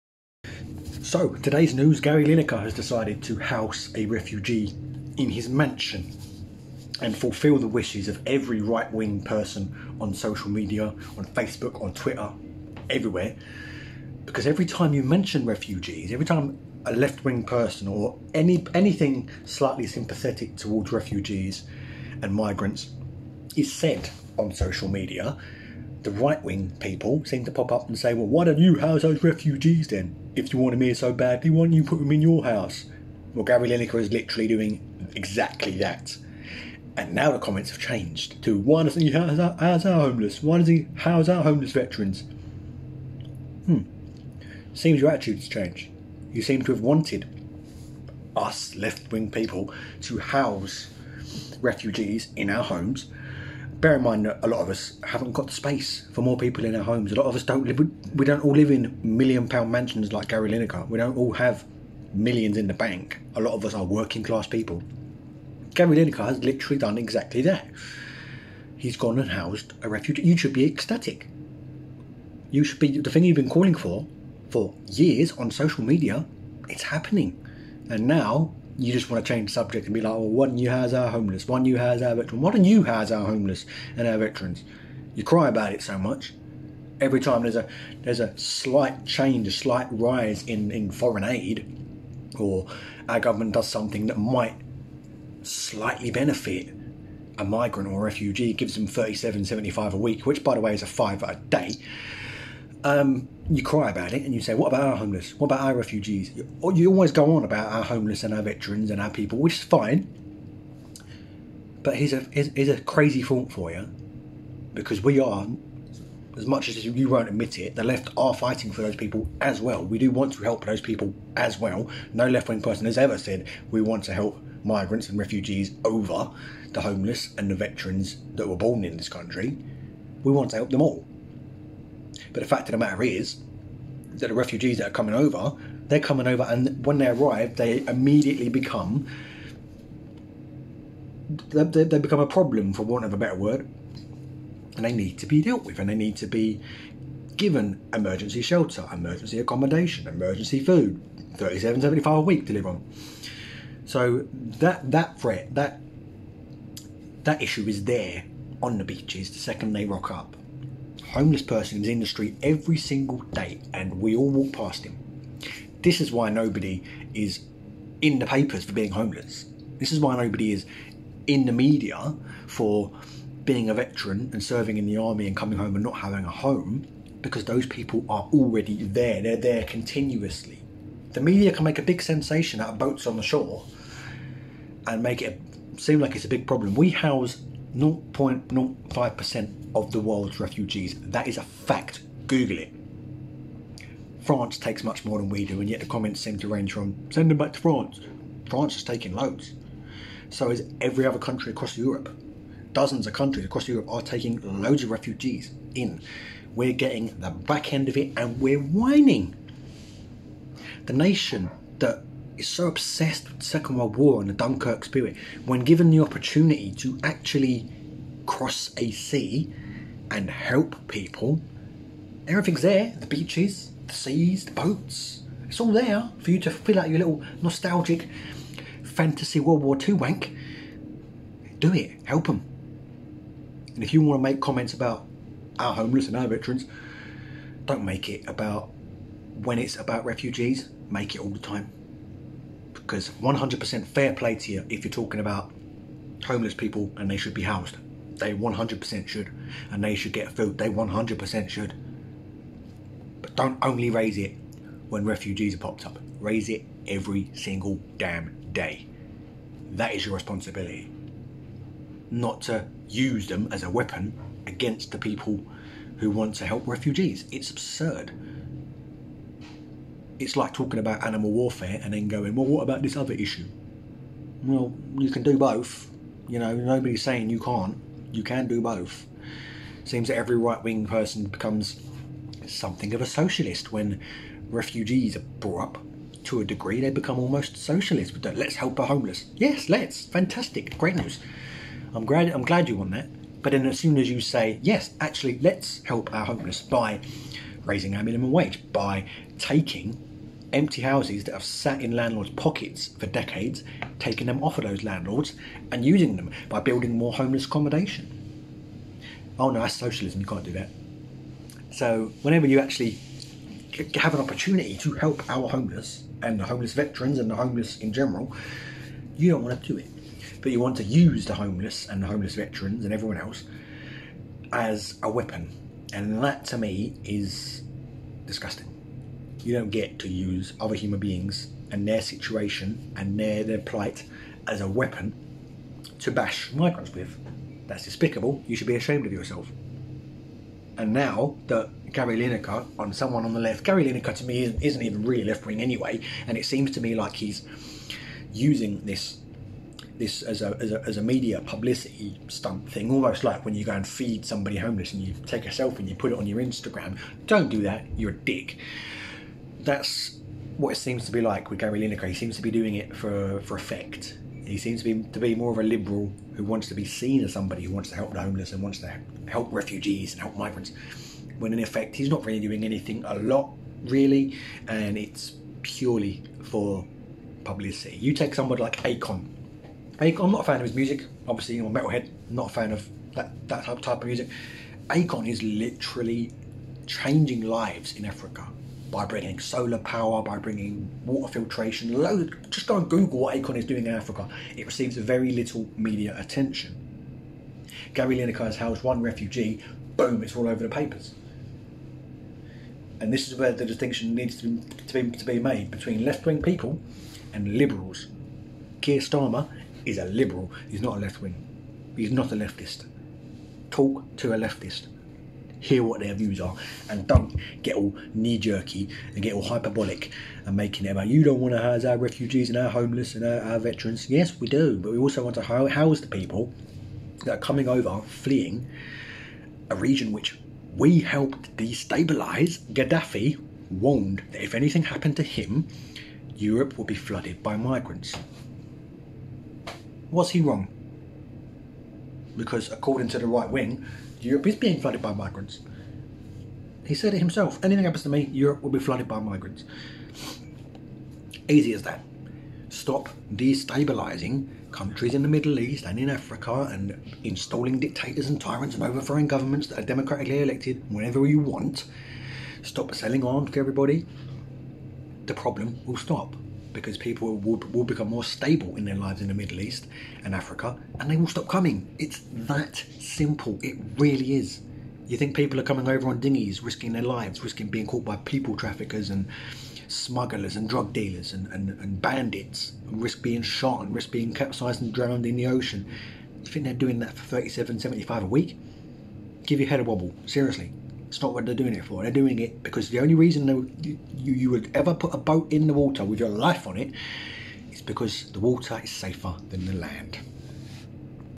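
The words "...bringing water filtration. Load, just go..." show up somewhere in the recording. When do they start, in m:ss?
6:30.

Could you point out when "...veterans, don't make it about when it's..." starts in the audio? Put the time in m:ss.
3:56.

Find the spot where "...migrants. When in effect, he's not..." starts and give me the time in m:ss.
6:10.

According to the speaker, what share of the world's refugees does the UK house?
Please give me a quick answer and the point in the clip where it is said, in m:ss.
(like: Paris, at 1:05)
0.05%, at 3:07.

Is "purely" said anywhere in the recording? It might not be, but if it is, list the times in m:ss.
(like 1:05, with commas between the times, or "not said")
6:15.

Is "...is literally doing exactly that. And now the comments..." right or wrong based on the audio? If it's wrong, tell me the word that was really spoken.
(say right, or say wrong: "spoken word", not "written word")
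right.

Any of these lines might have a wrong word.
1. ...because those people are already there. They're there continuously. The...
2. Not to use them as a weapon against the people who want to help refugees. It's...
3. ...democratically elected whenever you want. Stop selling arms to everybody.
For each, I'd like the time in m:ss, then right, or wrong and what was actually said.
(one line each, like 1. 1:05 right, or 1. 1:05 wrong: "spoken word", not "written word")
1. 2:57 right
2. 4:22 right
3. 7:39 right.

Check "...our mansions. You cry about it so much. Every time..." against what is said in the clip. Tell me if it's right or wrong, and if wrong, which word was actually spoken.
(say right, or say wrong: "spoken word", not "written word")
wrong: "veterans", not "mansions".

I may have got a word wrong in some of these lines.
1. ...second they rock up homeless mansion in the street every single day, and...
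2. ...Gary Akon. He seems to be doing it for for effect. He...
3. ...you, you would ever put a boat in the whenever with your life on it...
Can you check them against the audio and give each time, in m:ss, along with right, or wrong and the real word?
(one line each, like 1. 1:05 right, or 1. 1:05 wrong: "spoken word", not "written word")
1. 2:39 wrong: "person", not "mansion"
2. 6:01 wrong: "Lineker", not "Akon"
3. 8:14 wrong: "water", not "whenever".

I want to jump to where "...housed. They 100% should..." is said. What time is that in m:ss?
4:07.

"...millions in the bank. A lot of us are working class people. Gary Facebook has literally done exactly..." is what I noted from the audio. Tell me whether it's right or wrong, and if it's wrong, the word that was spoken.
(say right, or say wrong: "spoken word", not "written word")
wrong: "Lineker", not "Facebook".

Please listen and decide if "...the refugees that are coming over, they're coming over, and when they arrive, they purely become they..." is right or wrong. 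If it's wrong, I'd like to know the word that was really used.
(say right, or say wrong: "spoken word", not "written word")
wrong: "immediately", not "purely".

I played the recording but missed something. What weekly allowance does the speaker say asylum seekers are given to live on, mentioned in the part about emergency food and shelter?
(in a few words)
£37.75.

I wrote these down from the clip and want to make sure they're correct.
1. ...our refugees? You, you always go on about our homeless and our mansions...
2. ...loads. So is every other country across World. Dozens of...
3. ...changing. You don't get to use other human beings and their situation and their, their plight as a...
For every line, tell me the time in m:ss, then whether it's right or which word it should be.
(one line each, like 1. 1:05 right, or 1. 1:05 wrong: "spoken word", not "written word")
1. 1:45 wrong: "veterans", not "mansions"
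2. 3:19 wrong: "Europe", not "World"
3. 5:28 wrong: "disgusting", not "changing".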